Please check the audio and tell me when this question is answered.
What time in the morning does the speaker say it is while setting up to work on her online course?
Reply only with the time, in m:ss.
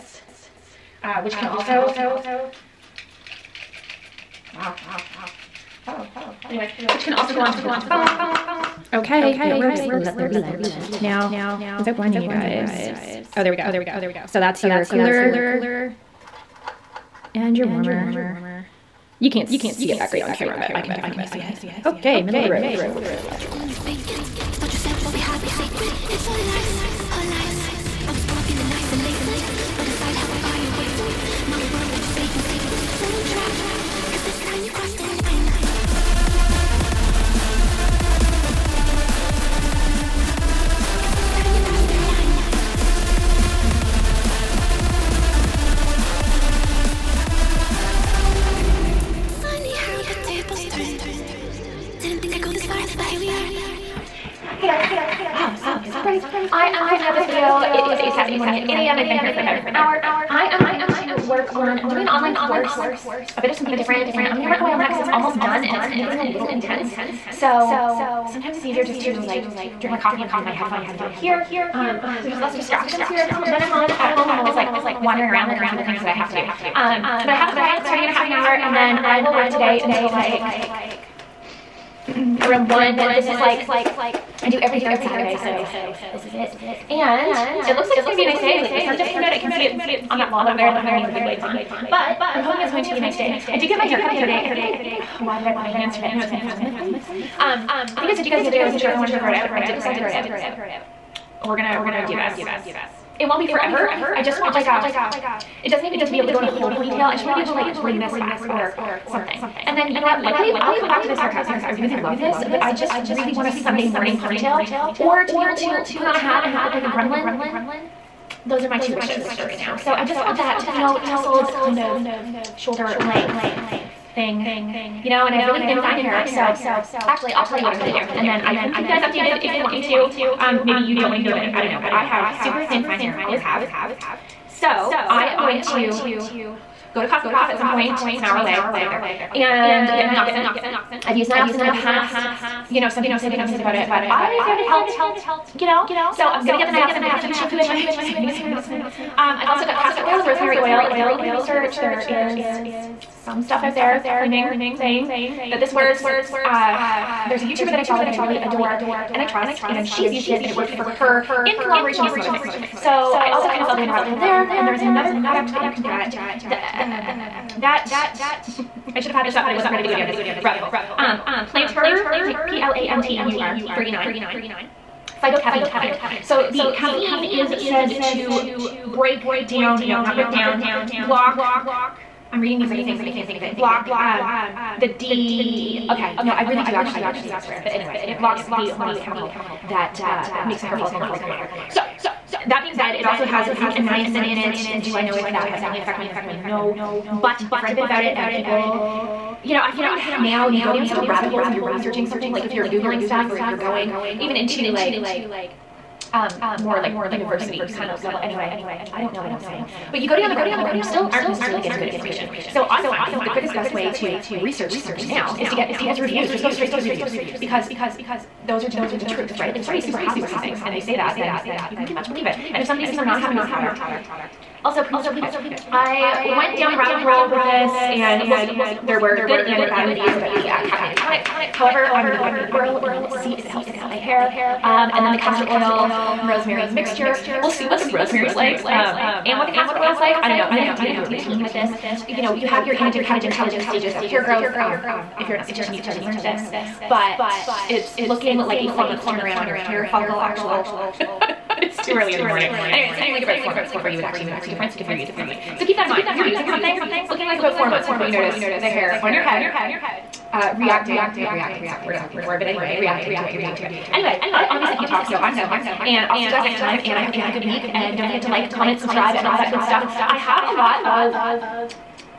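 0:58.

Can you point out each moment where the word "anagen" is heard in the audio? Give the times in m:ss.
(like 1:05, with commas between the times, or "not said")
4:02.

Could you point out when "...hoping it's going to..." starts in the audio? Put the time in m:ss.
1:32.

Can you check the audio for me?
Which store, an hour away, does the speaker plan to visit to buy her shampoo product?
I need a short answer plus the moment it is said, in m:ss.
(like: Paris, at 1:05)
Cosmoprof, at 2:17.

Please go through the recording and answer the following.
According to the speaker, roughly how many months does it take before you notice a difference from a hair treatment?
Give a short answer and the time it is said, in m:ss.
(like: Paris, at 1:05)
4 months, at 4:08.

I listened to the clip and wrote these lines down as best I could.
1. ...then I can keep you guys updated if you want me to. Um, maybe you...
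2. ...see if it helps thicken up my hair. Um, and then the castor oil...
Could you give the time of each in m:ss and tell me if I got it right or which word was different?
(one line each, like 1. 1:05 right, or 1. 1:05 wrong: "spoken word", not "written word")
1. 2:08 right
2. 3:53 right.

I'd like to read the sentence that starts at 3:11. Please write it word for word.
So, that being said, it also has zinc and niacin in it.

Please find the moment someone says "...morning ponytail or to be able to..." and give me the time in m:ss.
1:53.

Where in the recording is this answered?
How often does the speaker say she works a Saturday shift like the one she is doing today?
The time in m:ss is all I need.
1:24.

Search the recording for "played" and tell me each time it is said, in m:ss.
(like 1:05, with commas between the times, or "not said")
not said.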